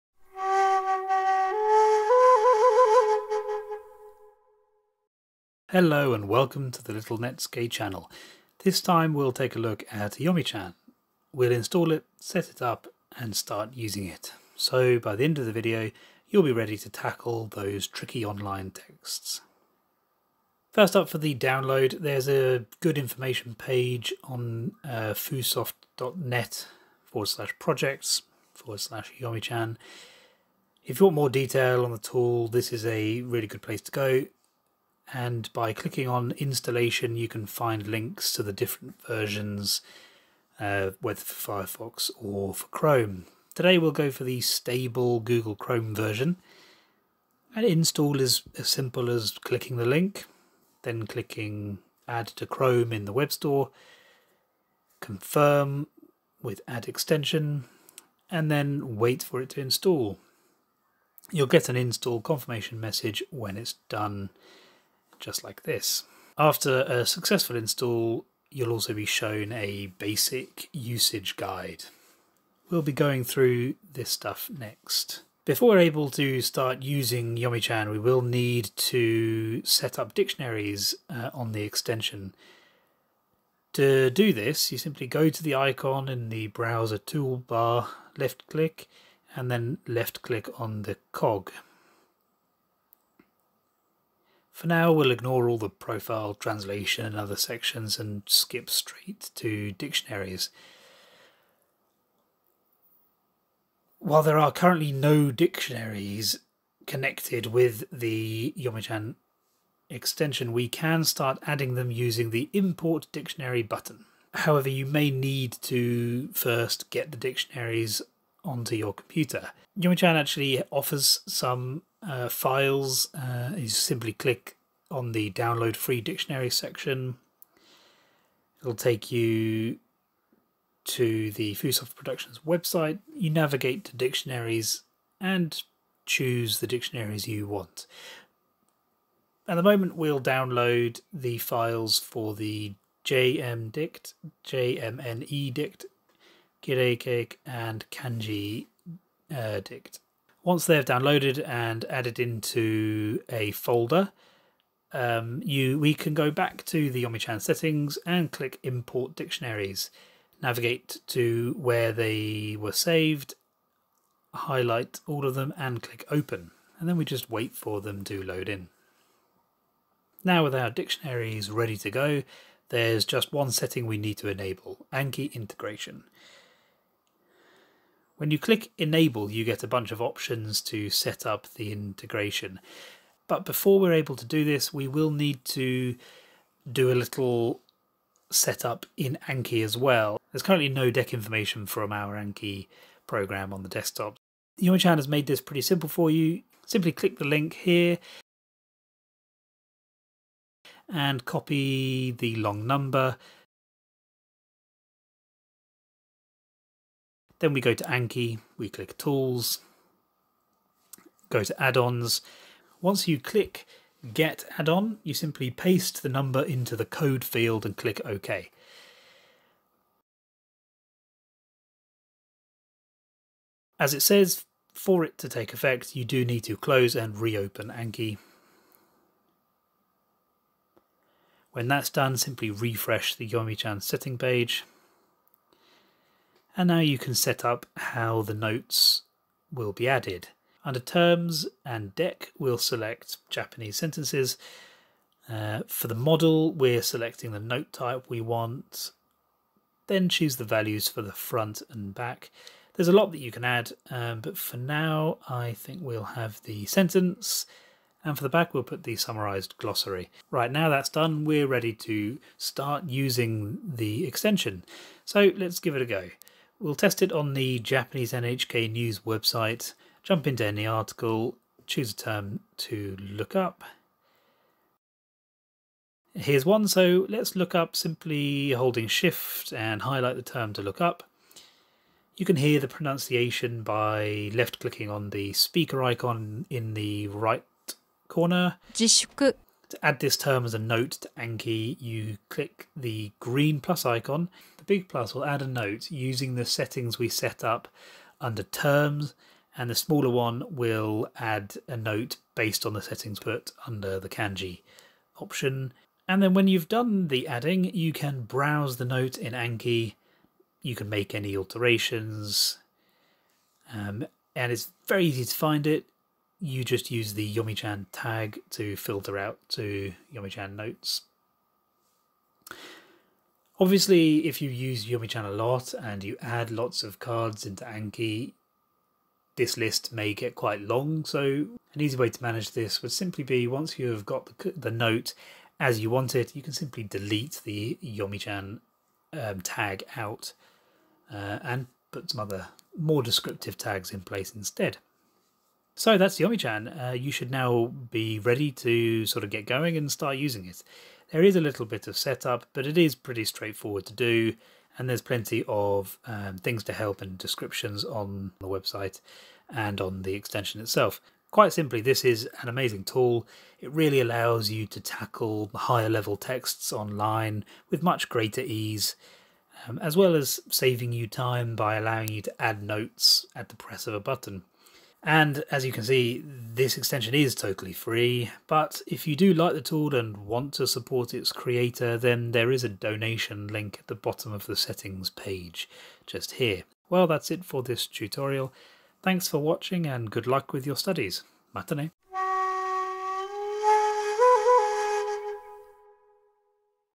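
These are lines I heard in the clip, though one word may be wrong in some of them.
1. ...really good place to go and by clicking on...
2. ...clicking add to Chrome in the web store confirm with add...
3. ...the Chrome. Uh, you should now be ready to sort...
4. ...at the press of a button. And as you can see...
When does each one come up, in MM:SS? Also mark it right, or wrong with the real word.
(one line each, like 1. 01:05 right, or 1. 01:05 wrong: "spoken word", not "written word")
1. 00:33 right
2. 00:51 right
3. 05:46 wrong: "Yomichan", not "Chrome"
4. 06:13 right.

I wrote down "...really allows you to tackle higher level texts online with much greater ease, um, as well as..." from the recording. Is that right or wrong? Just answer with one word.
right.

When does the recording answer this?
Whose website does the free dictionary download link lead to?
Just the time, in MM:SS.
02:11.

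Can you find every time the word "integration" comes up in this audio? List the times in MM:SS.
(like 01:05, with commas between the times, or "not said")
02:55, 03:01.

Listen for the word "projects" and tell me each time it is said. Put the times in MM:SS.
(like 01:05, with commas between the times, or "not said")
00:27.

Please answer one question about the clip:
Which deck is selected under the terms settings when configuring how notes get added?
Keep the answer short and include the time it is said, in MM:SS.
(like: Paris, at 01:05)
Japanese sentences, at 04:03.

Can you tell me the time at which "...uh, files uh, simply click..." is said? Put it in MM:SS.
02:02.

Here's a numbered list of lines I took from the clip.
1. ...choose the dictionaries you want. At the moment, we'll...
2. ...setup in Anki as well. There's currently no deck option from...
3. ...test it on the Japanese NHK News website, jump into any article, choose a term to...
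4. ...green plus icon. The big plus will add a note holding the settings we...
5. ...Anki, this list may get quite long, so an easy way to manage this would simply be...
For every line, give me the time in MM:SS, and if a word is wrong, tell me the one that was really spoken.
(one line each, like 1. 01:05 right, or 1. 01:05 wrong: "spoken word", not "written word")
1. 02:16 right
2. 03:08 wrong: "information", not "option"
3. 04:26 right
4. 04:53 wrong: "using", not "holding"
5. 05:27 right.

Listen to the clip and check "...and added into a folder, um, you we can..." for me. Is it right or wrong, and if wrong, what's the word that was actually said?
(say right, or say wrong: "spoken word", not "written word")
right.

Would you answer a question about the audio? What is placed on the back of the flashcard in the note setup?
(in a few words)
summarized glossary.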